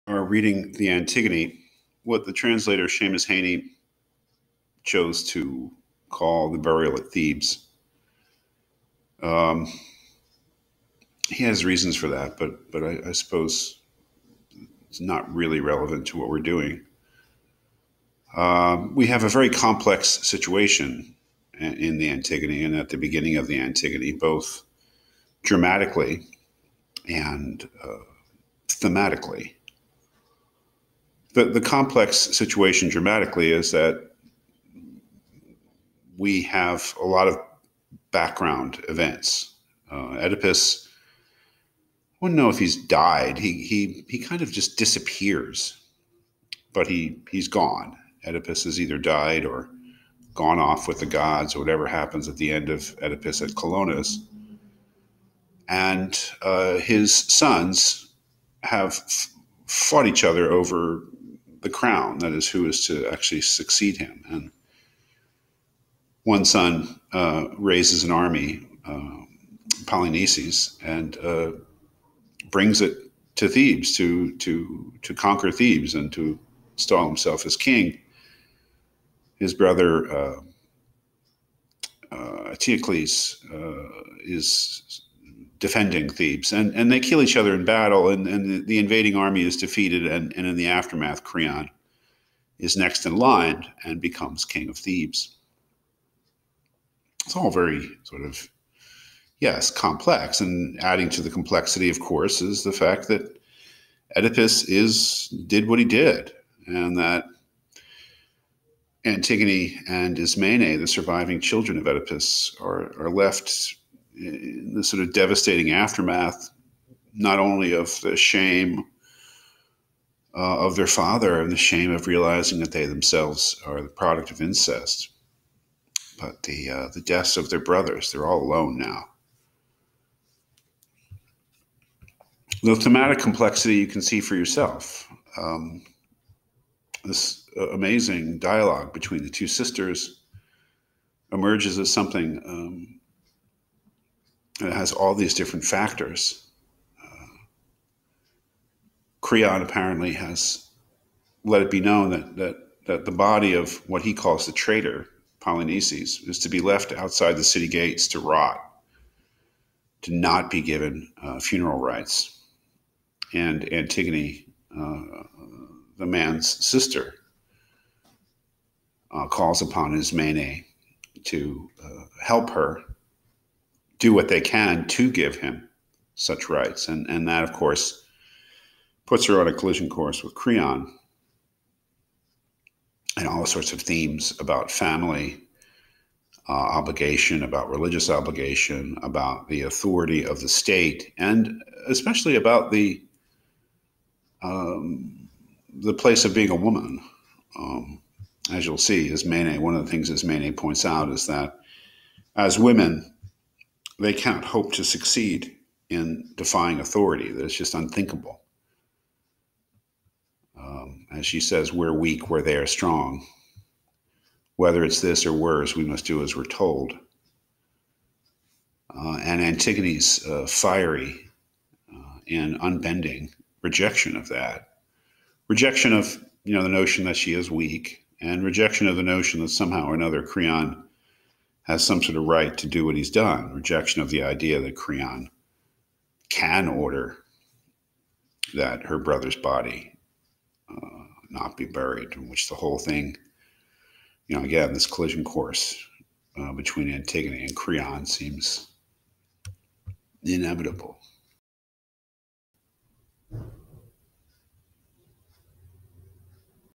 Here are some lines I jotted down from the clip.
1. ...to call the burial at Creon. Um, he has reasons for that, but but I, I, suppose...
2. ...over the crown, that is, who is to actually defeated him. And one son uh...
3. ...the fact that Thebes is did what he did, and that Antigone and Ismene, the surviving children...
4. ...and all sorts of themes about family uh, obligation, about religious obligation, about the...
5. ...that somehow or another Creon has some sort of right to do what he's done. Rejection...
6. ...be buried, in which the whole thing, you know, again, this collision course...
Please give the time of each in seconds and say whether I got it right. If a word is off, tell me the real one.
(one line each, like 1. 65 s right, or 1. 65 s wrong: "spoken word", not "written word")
1. 5 s wrong: "Thebes", not "Creon"
2. 60 s wrong: "succeed", not "defeated"
3. 102 s wrong: "Oedipus", not "Thebes"
4. 183 s right
5. 229 s right
6. 241 s right.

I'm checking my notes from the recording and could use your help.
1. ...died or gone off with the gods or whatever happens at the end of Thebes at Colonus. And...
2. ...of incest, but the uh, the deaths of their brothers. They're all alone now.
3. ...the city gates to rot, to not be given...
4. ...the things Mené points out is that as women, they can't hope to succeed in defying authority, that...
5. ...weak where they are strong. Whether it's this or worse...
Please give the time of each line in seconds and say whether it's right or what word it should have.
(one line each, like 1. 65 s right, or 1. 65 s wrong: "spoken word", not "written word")
1. 48 s wrong: "Oedipus", not "Thebes"
2. 124 s right
3. 157 s right
4. 199 s right
5. 211 s right.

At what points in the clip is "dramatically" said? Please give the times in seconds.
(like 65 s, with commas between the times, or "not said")
25 s, 32 s.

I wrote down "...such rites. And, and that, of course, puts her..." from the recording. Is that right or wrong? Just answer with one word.
right.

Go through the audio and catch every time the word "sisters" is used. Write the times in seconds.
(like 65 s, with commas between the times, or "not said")
139 s, 166 s.